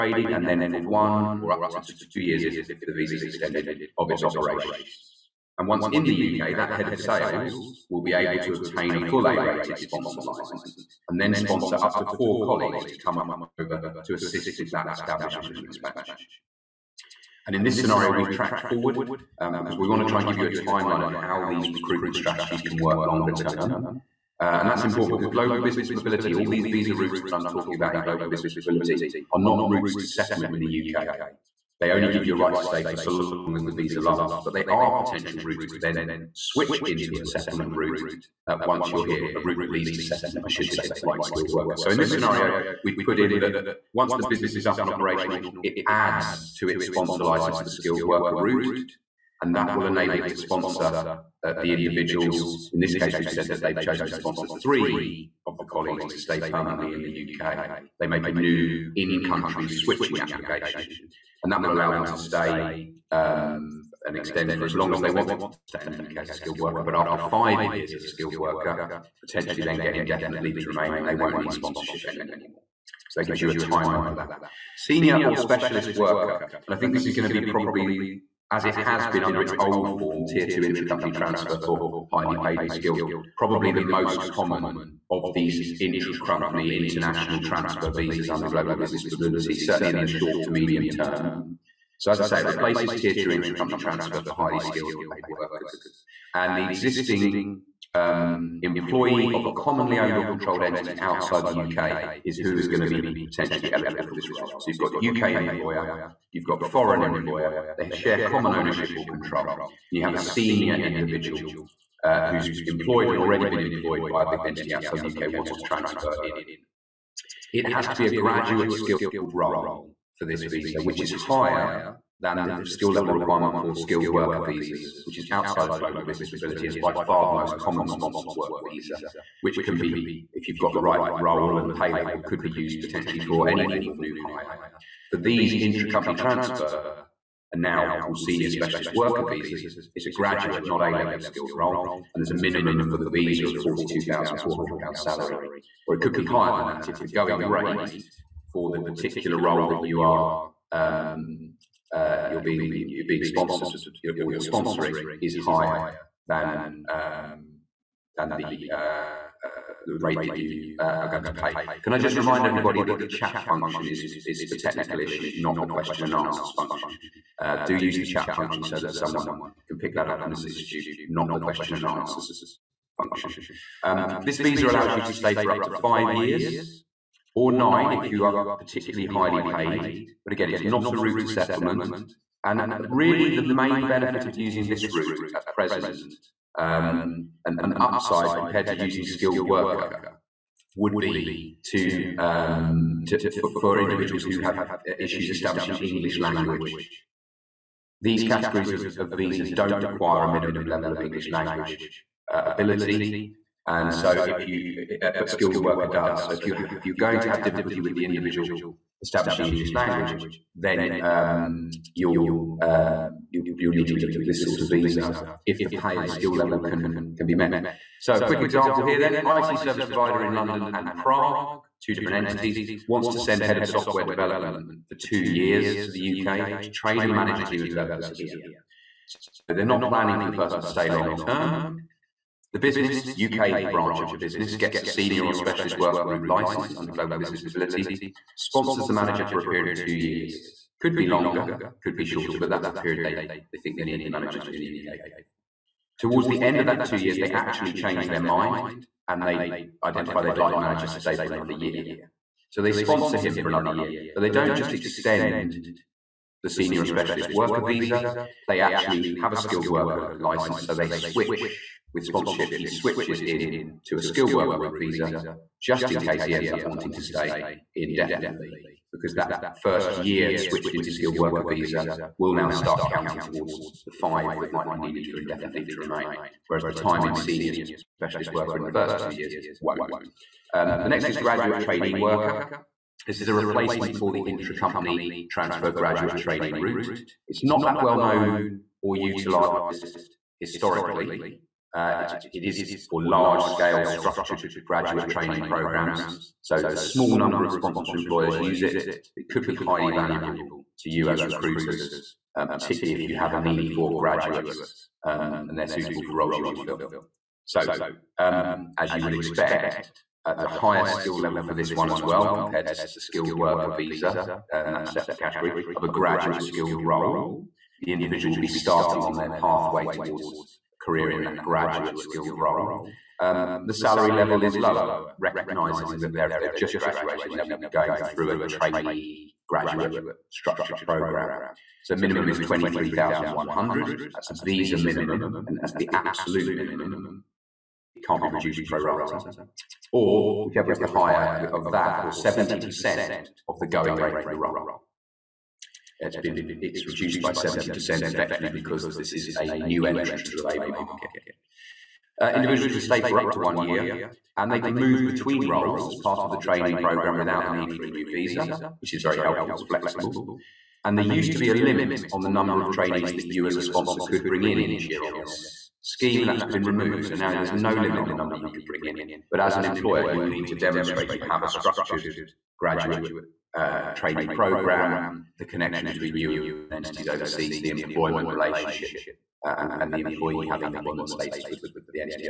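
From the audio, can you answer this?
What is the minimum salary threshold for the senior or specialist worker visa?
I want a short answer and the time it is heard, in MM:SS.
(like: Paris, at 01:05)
£42,400, at 02:23.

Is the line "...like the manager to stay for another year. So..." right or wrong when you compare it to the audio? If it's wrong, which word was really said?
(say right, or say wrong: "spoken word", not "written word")
right.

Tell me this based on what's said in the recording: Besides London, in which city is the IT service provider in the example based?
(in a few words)
Prague.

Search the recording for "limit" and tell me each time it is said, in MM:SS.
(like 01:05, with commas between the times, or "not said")
06:01, 06:07.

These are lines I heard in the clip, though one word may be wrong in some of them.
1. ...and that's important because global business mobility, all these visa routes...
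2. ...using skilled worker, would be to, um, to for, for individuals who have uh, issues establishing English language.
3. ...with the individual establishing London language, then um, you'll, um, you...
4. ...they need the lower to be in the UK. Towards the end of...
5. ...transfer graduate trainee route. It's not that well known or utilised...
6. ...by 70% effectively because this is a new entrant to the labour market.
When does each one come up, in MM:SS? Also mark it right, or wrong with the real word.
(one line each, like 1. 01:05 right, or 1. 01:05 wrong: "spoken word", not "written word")
1. 00:24 right
2. 03:08 right
3. 03:27 wrong: "English", not "London"
4. 04:03 wrong: "manager", not "lower"
5. 04:45 right
6. 05:47 right.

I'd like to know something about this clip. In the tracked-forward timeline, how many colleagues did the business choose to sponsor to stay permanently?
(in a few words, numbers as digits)
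3.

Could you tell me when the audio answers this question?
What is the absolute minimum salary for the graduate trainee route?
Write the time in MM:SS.
05:32.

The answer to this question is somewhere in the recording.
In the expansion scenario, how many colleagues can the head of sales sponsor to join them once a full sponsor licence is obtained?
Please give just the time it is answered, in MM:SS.
00:12.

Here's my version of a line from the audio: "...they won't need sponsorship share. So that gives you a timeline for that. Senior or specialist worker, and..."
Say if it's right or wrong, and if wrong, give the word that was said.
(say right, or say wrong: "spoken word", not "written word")
wrong: "anymore", not "share".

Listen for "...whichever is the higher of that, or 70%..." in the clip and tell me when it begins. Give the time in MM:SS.
05:40.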